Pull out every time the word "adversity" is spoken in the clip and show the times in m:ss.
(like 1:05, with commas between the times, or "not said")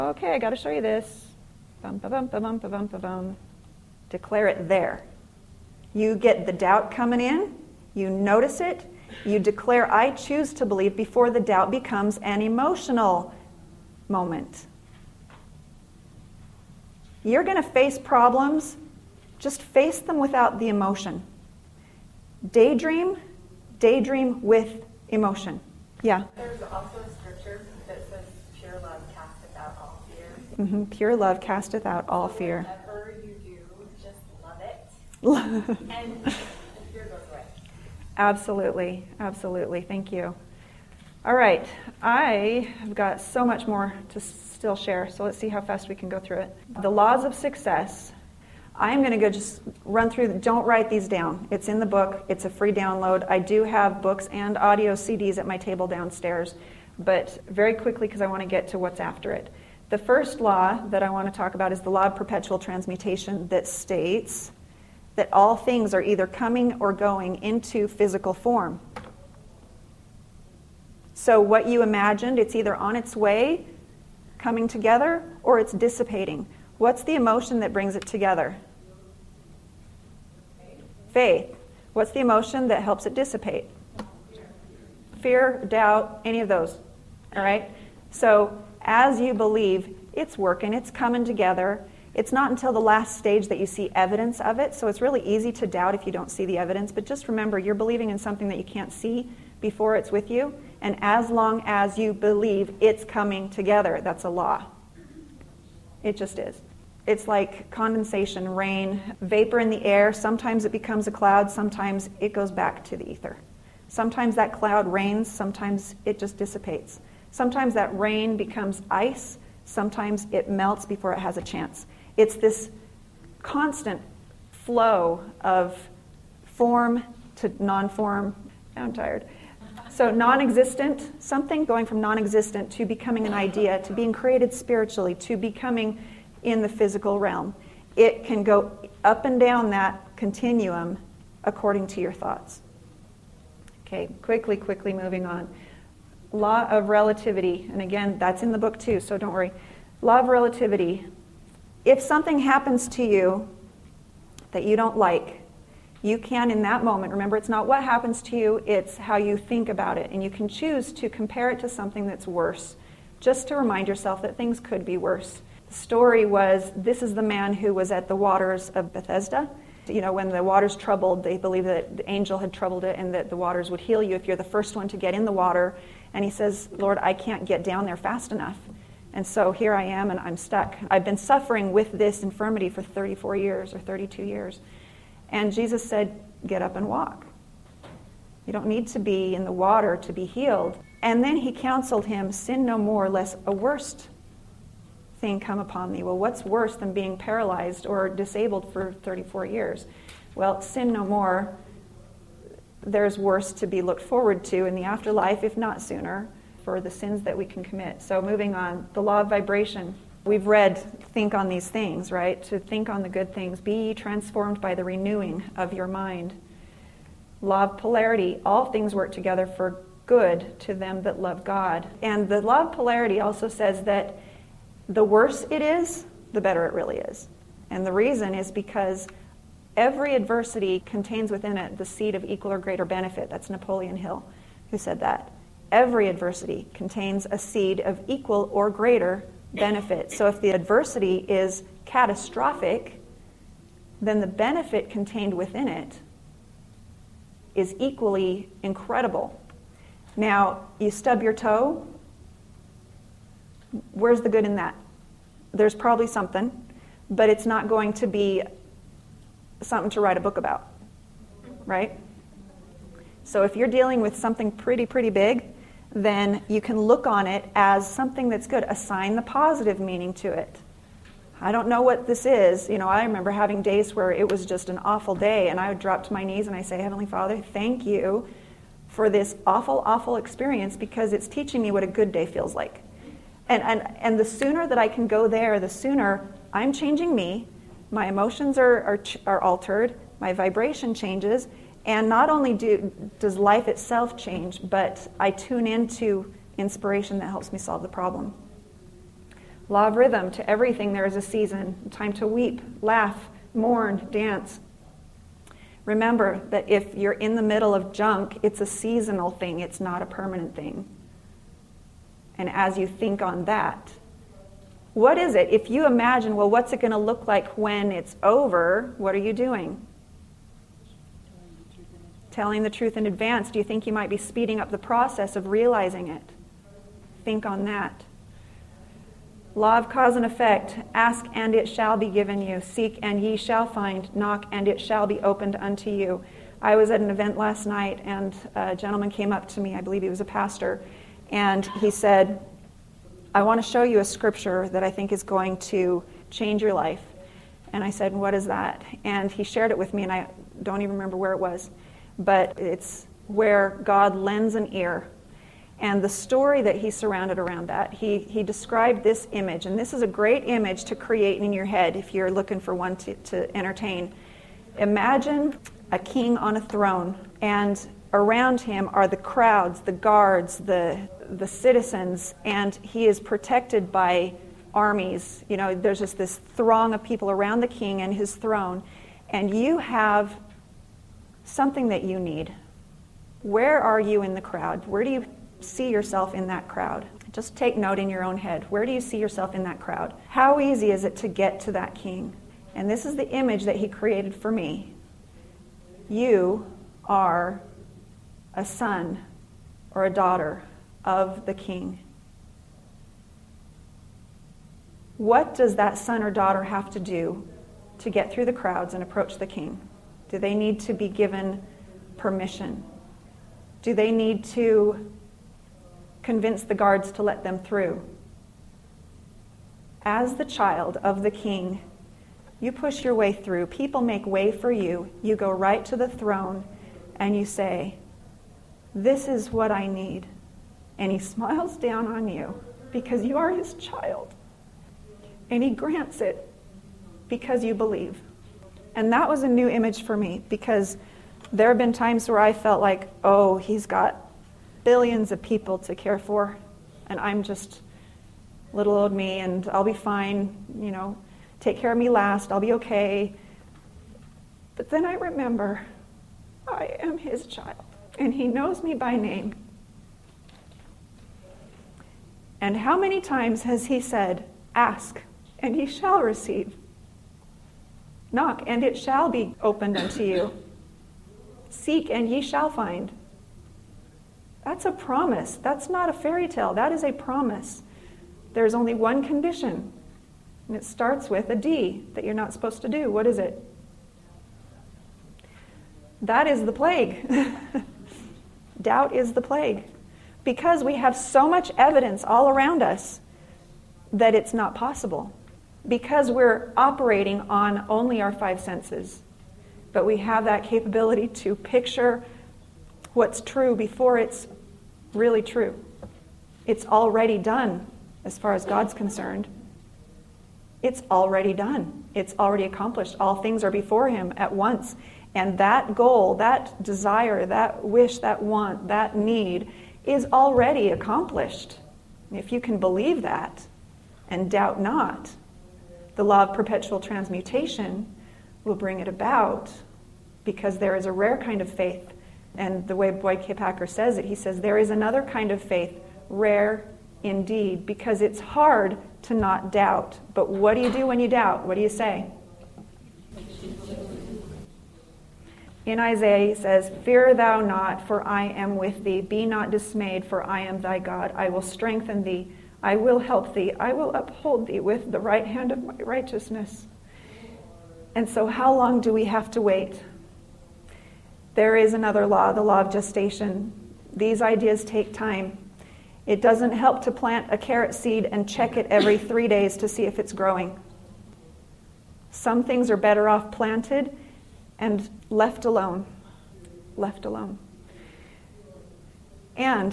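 3:50, 3:56, 4:00.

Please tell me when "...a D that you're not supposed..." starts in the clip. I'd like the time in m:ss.
8:01.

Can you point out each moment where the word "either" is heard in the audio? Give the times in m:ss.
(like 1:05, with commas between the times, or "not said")
1:06, 1:12.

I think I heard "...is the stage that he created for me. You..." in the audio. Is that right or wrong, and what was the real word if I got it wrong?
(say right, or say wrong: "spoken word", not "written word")
wrong: "image", not "stage".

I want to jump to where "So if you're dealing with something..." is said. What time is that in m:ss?
4:23.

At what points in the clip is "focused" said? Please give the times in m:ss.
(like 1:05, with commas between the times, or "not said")
not said.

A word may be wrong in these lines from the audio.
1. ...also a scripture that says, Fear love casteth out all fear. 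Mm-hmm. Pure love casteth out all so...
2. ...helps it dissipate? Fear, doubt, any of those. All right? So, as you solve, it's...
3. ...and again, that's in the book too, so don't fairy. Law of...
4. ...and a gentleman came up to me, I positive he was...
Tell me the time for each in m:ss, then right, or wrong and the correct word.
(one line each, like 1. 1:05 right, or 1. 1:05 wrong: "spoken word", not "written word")
1. 0:26 wrong: "Pure", not "Fear"
2. 1:22 wrong: "believe", not "solve"
3. 2:27 wrong: "worry", not "fairy"
4. 5:38 wrong: "believe", not "positive".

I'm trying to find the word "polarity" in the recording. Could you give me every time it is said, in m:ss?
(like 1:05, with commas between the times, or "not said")
3:37, 3:42.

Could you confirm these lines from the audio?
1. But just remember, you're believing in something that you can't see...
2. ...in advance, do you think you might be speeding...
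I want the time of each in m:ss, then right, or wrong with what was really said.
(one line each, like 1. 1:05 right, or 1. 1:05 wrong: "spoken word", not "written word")
1. 1:36 right
2. 5:22 right.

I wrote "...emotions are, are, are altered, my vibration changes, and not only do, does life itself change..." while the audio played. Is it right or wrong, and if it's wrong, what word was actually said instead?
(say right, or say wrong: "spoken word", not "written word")
right.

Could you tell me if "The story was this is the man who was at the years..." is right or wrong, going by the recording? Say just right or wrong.
wrong.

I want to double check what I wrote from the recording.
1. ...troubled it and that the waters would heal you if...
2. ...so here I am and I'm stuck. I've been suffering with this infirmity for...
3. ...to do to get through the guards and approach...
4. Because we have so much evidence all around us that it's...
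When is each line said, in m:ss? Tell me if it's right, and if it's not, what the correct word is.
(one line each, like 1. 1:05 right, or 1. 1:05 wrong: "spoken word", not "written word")
1. 2:52 right
2. 2:59 right
3. 6:46 wrong: "crowds", not "guards"
4. 8:10 right.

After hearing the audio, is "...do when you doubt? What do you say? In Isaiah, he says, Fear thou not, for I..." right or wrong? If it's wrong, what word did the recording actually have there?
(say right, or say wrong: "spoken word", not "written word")
right.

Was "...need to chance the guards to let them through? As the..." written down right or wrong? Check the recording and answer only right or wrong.
wrong.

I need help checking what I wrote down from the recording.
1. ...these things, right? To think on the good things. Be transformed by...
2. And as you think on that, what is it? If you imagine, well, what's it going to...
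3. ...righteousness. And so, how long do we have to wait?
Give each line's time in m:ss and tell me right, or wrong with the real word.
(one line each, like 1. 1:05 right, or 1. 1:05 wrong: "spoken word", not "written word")
1. 3:31 right
2. 5:12 right
3. 9:15 right.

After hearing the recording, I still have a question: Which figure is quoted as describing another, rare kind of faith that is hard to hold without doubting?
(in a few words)
Boyd K. Packer.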